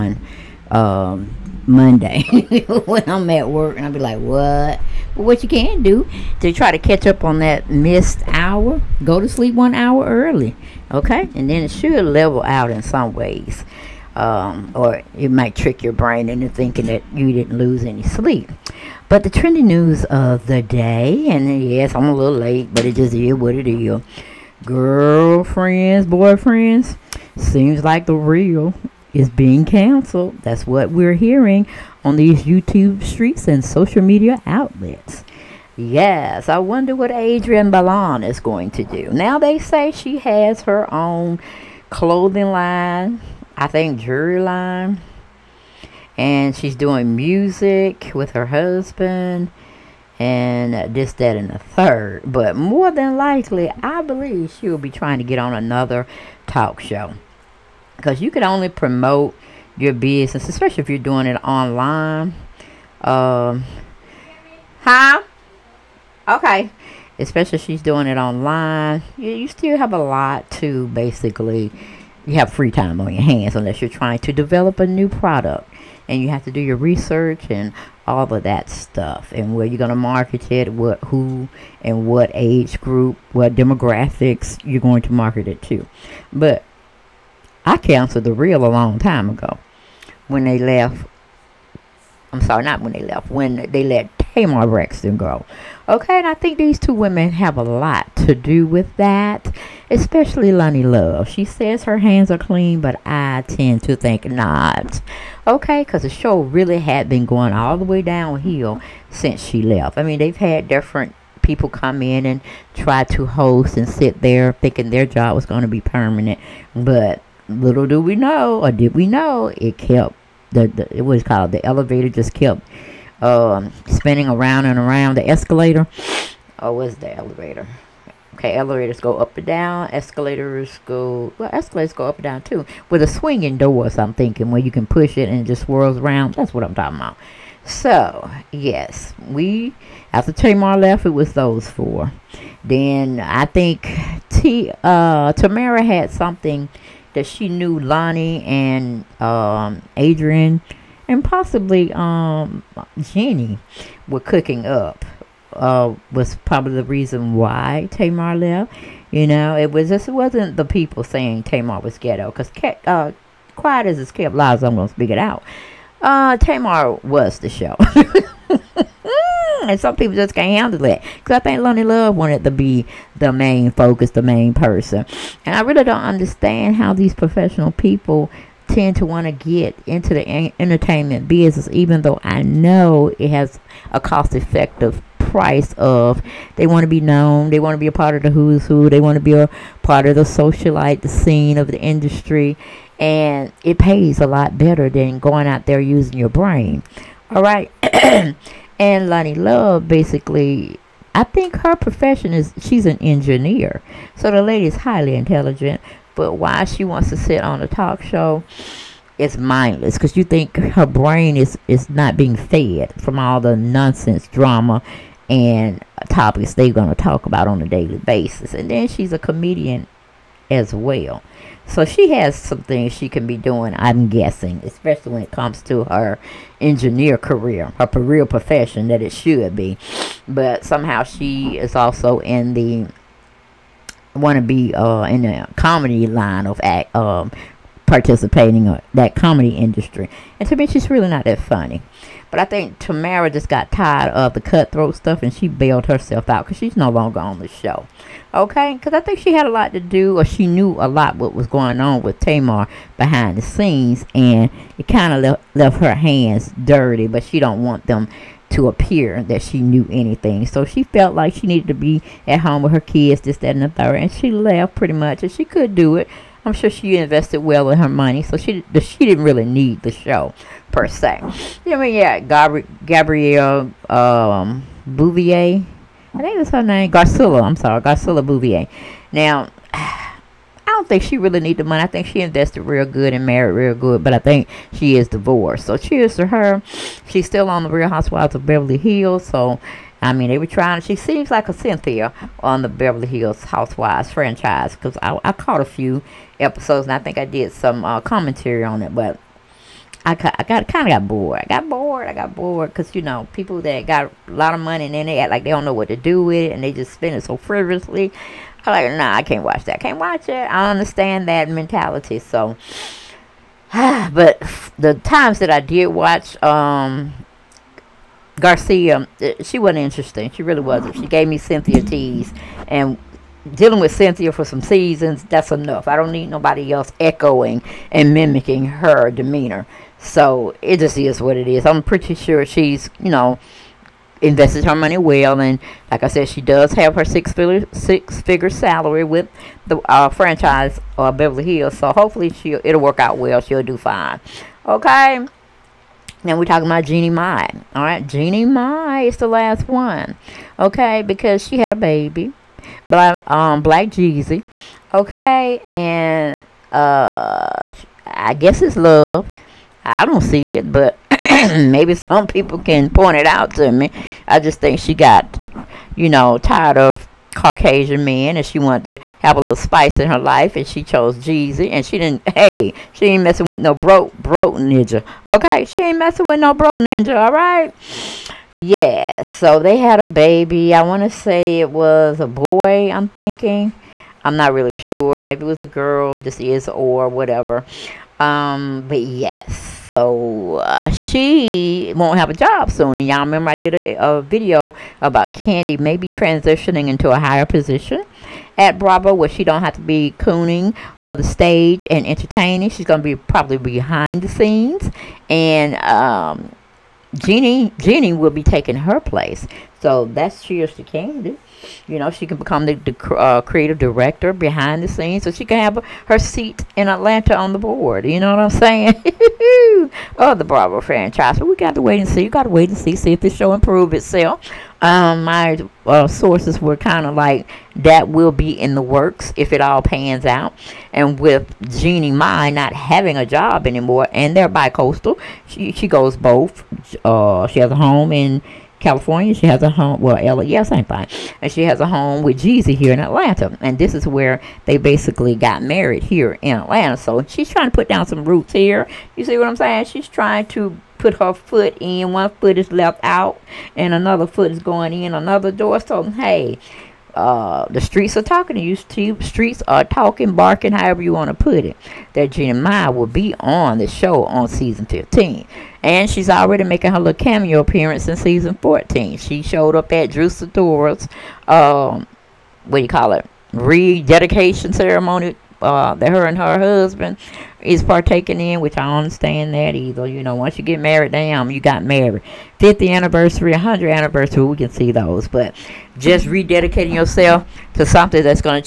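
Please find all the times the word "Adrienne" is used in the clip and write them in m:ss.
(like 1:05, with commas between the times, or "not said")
0:37, 2:29.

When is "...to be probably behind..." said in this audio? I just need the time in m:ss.
6:43.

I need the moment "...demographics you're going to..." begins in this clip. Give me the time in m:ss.
1:23.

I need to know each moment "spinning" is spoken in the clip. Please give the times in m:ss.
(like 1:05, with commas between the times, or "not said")
2:03.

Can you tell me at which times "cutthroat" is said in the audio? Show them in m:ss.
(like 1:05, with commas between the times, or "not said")
4:04.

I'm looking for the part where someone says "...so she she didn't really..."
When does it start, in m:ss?
4:28.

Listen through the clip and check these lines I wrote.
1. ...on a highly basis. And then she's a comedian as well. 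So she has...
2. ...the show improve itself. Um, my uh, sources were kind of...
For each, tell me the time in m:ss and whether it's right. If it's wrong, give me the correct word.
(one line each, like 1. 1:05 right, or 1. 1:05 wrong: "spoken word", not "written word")
1. 3:37 wrong: "daily", not "highly"
2. 7:03 right.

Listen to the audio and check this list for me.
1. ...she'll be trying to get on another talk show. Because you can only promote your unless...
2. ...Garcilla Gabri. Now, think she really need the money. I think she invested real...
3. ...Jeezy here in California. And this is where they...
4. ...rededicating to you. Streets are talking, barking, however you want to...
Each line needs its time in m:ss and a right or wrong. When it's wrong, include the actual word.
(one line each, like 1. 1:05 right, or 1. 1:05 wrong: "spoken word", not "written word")
1. 0:54 wrong: "business", not "unless"
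2. 4:37 wrong: "Beauvais", not "Gabri"
3. 7:22 wrong: "Atlanta", not "California"
4. 7:38 wrong: "talking", not "rededicating".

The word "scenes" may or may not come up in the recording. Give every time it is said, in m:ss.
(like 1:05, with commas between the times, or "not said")
3:11, 4:13, 6:44, 6:54.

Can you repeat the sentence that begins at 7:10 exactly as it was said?
And with Jeannie Mai not having a job anymore, and they're bi-coastal, she, she goes both.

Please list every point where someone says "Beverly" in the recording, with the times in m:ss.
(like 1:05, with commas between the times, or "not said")
4:48, 4:52, 5:41.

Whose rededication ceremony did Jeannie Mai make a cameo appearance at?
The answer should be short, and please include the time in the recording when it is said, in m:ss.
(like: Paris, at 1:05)
Drew Sidora, at 7:50.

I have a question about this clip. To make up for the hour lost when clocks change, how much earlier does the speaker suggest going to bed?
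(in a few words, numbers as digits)
1 hour.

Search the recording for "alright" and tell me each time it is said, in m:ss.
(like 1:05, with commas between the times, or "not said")
6:17.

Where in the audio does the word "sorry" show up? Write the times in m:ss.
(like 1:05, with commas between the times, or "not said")
1:32, 4:37.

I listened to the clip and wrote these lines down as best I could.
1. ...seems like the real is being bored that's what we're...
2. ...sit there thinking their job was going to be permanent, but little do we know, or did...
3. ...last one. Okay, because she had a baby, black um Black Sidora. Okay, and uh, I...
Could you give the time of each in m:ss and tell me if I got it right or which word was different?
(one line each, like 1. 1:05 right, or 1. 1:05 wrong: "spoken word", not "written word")
1. 0:27 wrong: "canceled", not "bored"
2. 1:53 right
3. 5:49 wrong: "Jeezy", not "Sidora".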